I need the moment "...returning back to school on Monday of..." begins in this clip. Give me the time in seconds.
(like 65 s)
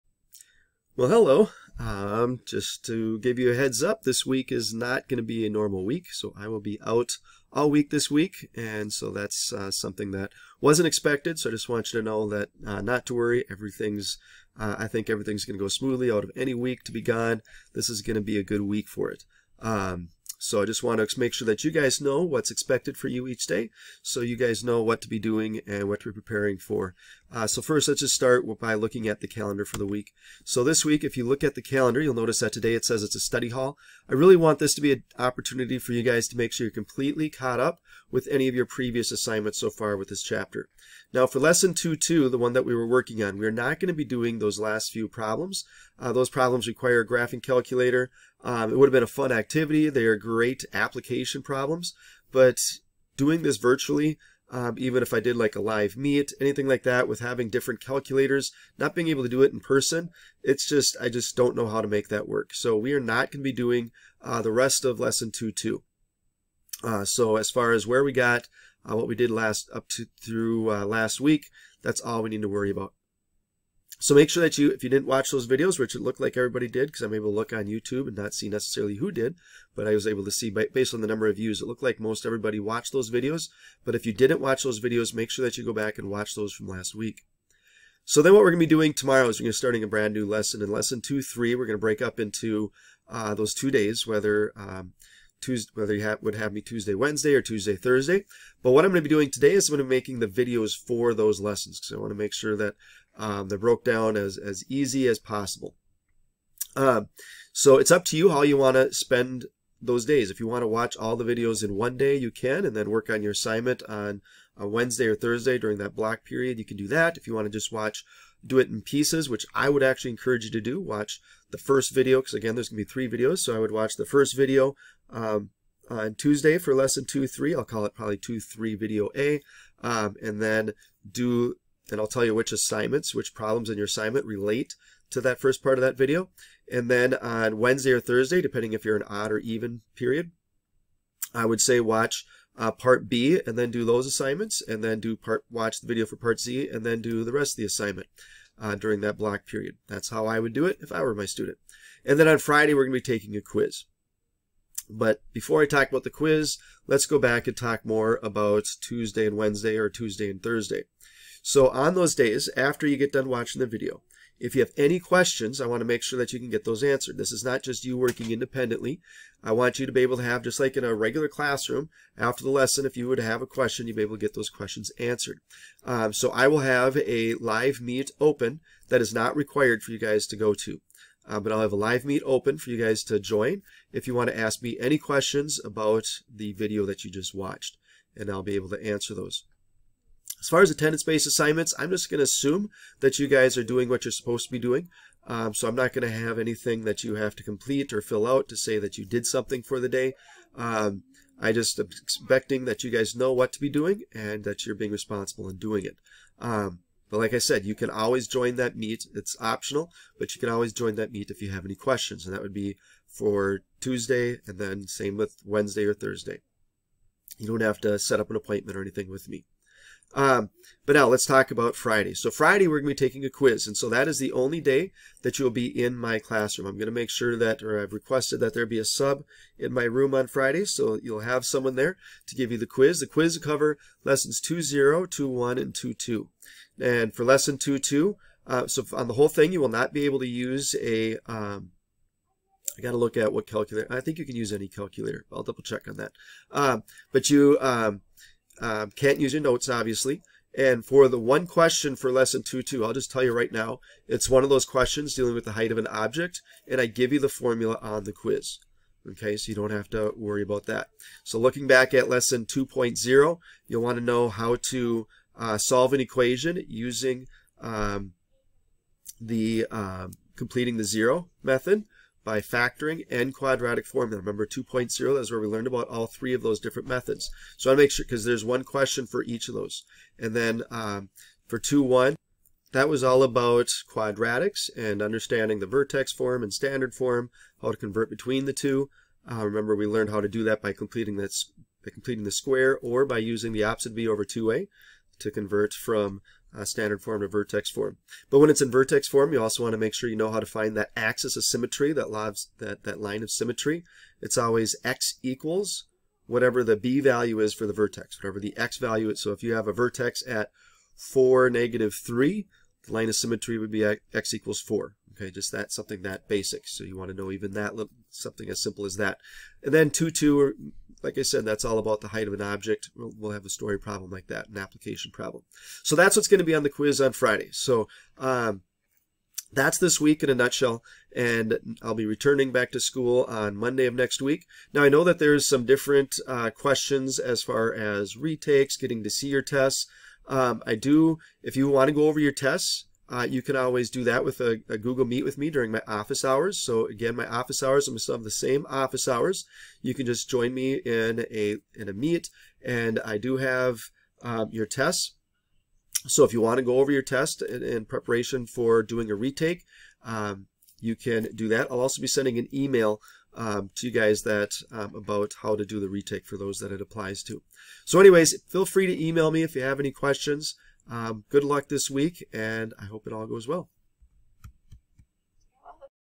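332 s.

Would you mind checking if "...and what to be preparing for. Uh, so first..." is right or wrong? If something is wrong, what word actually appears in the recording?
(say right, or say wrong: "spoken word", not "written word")
right.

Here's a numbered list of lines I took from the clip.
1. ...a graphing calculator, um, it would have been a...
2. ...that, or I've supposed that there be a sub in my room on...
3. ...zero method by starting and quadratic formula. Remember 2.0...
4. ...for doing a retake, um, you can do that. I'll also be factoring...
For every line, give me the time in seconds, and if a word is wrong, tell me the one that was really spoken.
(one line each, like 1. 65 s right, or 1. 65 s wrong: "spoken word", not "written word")
1. 47 s right
2. 227 s wrong: "requested", not "supposed"
3. 270 s wrong: "factoring", not "starting"
4. 358 s wrong: "sending", not "factoring".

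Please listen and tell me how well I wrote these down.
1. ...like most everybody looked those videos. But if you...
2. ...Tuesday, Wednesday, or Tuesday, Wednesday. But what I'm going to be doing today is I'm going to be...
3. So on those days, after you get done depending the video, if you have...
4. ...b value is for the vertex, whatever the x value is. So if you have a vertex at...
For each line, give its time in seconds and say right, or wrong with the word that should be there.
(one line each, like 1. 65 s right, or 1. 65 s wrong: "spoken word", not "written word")
1. 81 s wrong: "watched", not "looked"
2. 96 s wrong: "Thursday", not "Wednesday"
3. 161 s wrong: "watching", not "depending"
4. 306 s right.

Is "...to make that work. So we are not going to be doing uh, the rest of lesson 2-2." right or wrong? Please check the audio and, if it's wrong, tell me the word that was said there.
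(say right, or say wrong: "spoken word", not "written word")
right.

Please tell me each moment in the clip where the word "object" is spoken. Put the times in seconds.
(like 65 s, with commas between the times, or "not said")
255 s, 322 s.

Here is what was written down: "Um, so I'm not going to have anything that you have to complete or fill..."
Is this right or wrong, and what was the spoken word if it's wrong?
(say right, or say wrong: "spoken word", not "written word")
right.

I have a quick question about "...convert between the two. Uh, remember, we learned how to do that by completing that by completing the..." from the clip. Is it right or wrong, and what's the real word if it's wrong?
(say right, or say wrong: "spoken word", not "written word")
right.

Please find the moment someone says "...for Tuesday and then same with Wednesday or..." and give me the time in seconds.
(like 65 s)
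213 s.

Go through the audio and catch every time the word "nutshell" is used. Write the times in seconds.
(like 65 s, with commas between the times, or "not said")
330 s.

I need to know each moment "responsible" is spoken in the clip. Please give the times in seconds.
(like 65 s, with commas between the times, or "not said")
204 s.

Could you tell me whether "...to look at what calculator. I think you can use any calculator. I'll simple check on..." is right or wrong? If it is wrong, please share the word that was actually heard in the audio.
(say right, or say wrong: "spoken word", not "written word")
wrong: "double", not "simple".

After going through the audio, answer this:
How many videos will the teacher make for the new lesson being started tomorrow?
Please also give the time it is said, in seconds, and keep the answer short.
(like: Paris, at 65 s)
3, at 122 s.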